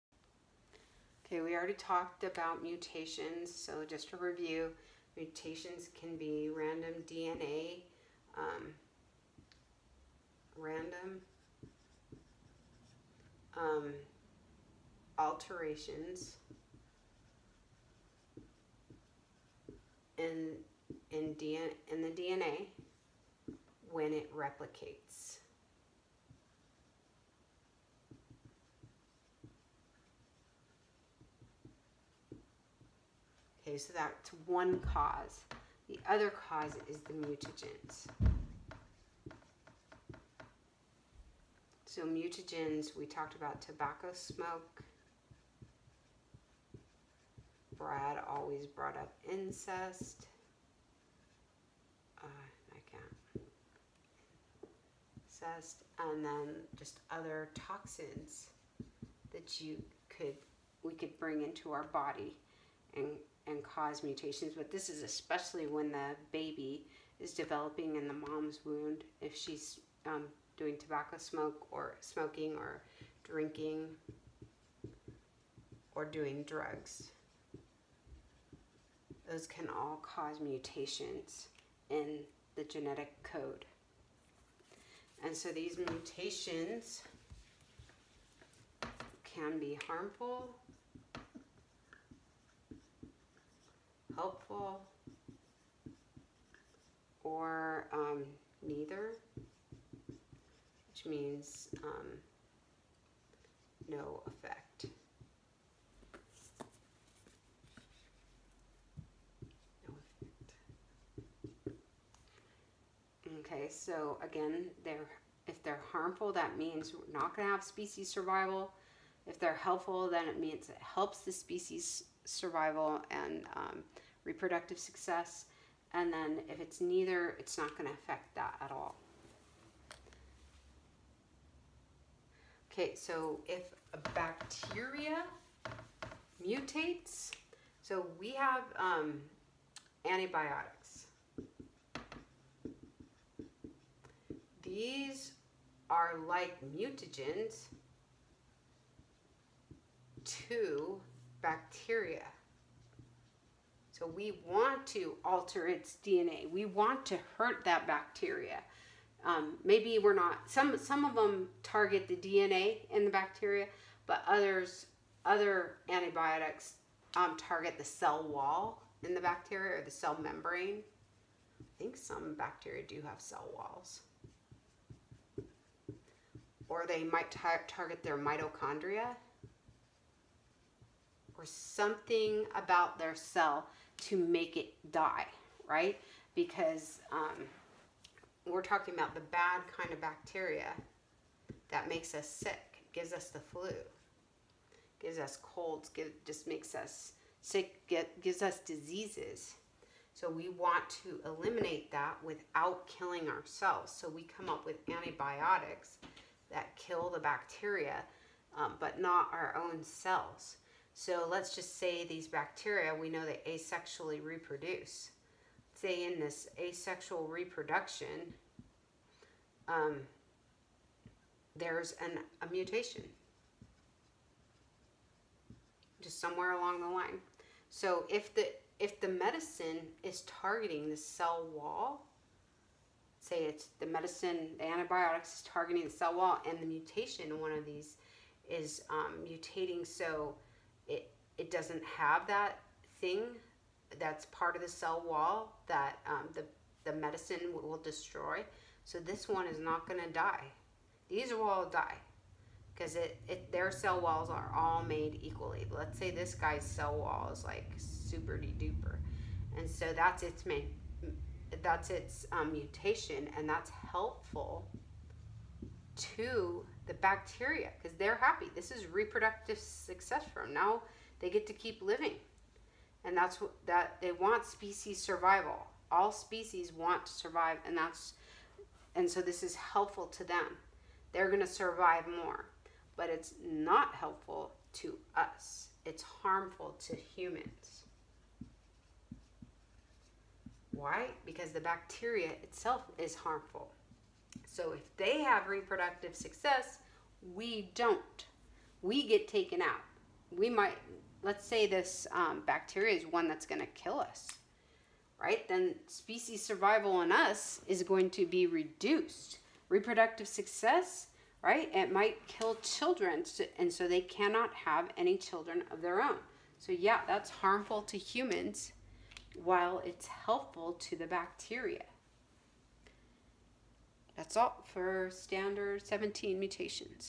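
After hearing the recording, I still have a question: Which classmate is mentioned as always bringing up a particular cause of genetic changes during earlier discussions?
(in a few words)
Brad.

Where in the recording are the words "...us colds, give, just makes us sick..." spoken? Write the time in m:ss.
3:15.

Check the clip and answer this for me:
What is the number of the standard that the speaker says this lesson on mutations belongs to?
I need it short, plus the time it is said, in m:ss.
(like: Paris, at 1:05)
17, at 5:25.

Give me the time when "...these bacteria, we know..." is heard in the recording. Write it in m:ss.
3:32.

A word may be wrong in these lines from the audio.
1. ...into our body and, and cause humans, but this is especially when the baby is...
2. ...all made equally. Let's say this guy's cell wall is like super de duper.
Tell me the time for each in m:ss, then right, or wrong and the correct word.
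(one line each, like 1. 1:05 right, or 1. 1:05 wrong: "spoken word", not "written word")
1. 1:01 wrong: "mutations", not "humans"
2. 4:14 right.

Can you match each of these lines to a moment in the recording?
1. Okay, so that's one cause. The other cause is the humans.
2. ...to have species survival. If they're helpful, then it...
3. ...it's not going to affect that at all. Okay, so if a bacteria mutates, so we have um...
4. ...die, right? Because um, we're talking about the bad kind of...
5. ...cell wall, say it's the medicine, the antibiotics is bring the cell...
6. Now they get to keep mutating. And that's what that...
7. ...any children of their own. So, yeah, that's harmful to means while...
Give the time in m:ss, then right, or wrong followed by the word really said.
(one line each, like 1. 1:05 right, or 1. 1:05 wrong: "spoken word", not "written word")
1. 0:33 wrong: "mutagens", not "humans"
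2. 1:57 right
3. 2:07 right
4. 3:04 right
5. 3:50 wrong: "targeting", not "bring"
6. 4:30 wrong: "living", not "mutating"
7. 5:14 wrong: "humans", not "means".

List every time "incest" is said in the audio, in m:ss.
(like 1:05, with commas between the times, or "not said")
0:49, 0:55.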